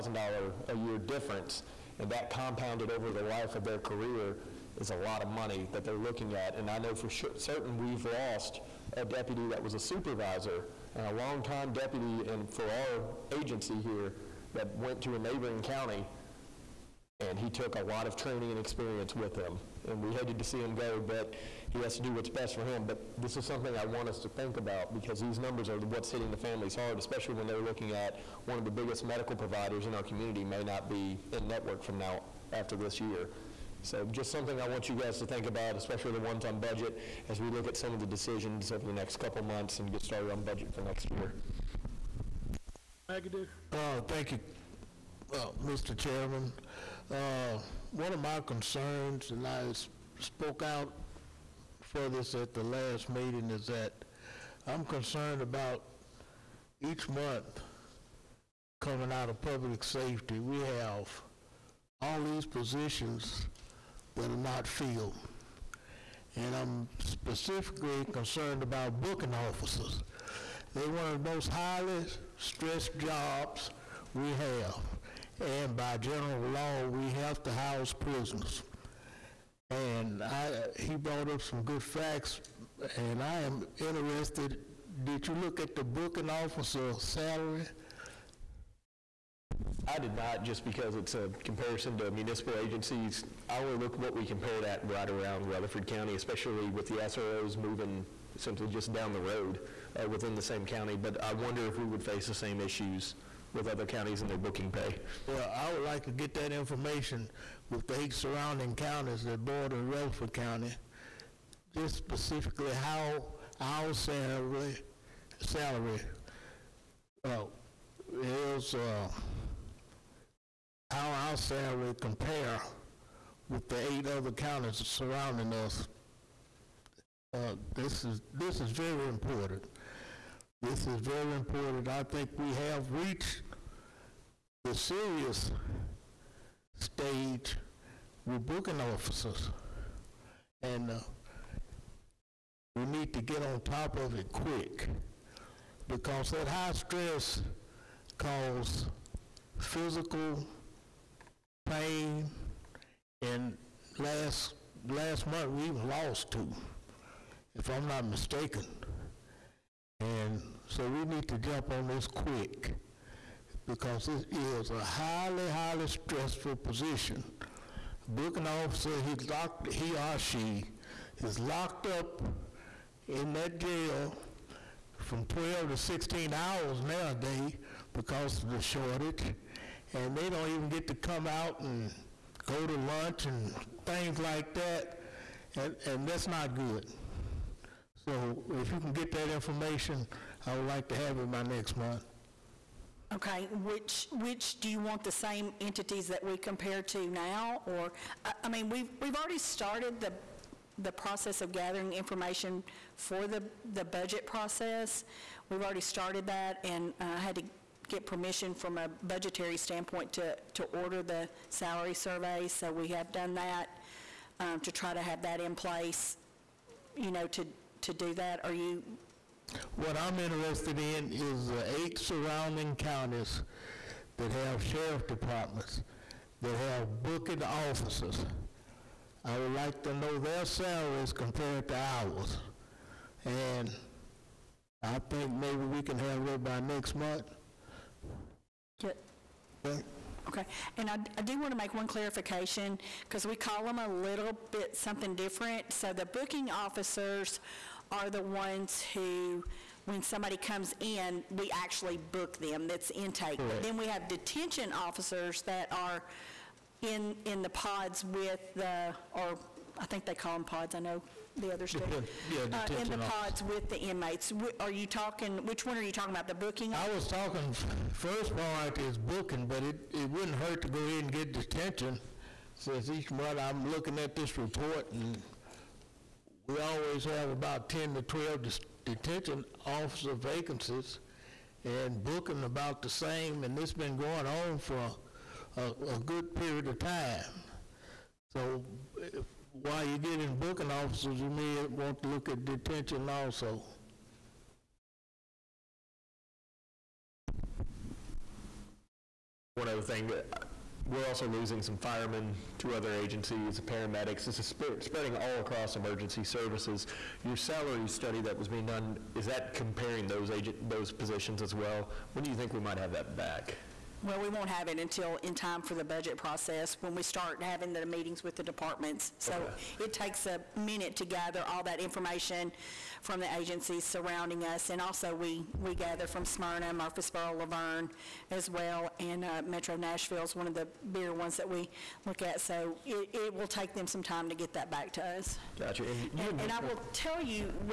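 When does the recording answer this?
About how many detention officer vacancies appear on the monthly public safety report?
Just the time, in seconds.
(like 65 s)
277 s.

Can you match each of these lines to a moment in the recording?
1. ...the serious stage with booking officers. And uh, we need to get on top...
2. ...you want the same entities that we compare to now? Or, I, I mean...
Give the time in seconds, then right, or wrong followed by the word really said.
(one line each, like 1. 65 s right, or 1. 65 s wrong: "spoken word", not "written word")
1. 134 s right
2. 194 s right.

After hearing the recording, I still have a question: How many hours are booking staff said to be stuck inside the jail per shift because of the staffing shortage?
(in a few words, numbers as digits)
12 to 16.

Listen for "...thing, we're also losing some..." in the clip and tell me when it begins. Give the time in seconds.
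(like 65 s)
299 s.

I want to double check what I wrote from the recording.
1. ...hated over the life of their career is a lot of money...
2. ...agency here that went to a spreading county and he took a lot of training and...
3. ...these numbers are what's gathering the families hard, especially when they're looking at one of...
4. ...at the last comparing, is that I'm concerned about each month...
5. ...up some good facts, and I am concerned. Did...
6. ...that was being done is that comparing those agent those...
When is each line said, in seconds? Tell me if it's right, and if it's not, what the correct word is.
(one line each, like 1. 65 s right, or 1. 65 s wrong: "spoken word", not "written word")
1. 2 s wrong: "compounded", not "hated"
2. 13 s wrong: "neighboring", not "spreading"
3. 25 s wrong: "hitting", not "gathering"
4. 52 s wrong: "meeting", not "comparing"
5. 81 s wrong: "interested", not "concerned"
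6. 308 s right.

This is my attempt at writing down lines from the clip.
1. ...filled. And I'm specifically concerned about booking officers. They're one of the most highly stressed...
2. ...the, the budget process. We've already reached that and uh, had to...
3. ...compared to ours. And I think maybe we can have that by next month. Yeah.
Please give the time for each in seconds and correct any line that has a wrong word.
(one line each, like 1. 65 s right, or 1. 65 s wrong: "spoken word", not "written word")
1. 64 s right
2. 203 s wrong: "started", not "reached"
3. 231 s right.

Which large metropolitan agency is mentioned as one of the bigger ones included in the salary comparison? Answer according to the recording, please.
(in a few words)
Metro Nashville.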